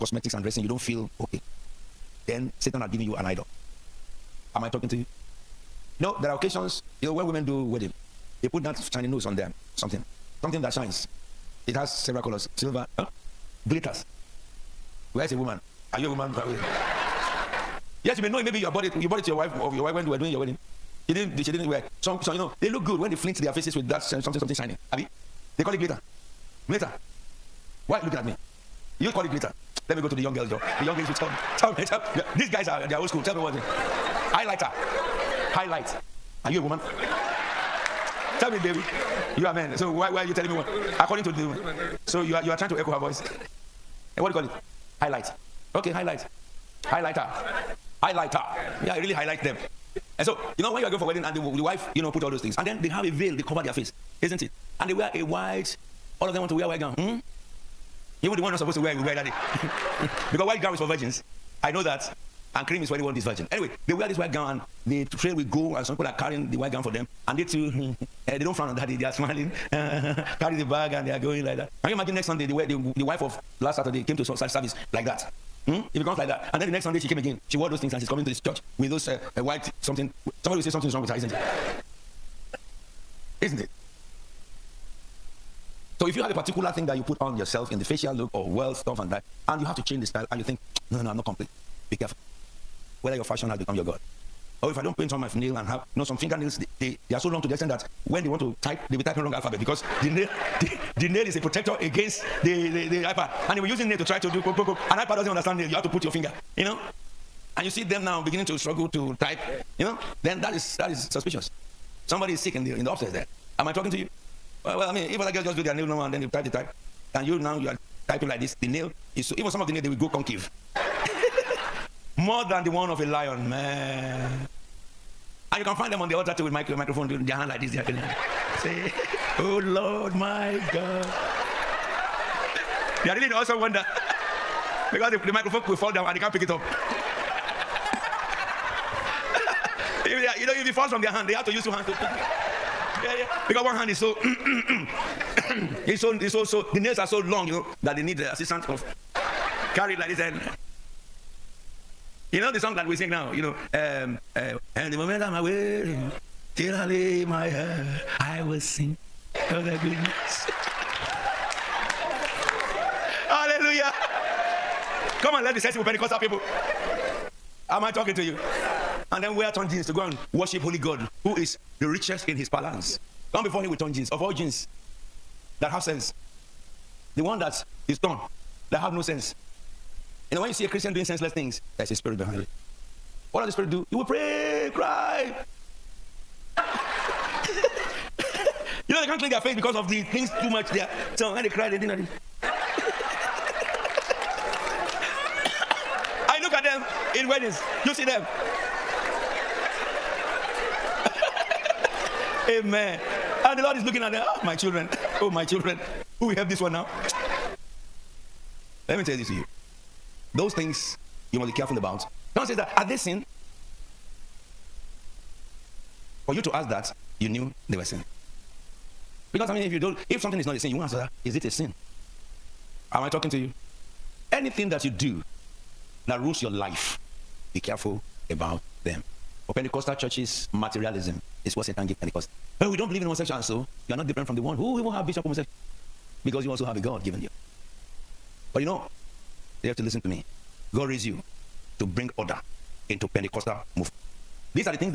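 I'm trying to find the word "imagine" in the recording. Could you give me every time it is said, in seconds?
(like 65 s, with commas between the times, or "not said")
71 s.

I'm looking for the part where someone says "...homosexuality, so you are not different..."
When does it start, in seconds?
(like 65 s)
233 s.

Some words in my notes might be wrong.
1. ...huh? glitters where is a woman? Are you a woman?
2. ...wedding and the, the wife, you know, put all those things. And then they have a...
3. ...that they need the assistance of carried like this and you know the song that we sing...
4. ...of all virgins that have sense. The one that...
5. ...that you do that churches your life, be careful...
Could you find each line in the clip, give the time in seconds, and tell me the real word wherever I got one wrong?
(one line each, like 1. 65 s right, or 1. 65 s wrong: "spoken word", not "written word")
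1. 12 s right
2. 51 s right
3. 147 s right
4. 174 s wrong: "jeans", not "virgins"
5. 224 s wrong: "rules", not "churches".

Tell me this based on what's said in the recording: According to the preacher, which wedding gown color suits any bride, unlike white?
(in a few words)
Cream.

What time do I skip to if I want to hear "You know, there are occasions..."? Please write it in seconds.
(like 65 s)
5 s.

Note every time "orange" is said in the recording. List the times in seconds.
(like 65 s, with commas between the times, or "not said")
not said.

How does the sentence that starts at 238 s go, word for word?
But you know, you have to listen to me.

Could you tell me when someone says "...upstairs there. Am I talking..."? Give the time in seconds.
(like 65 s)
112 s.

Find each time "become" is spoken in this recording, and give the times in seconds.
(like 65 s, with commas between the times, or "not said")
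93 s.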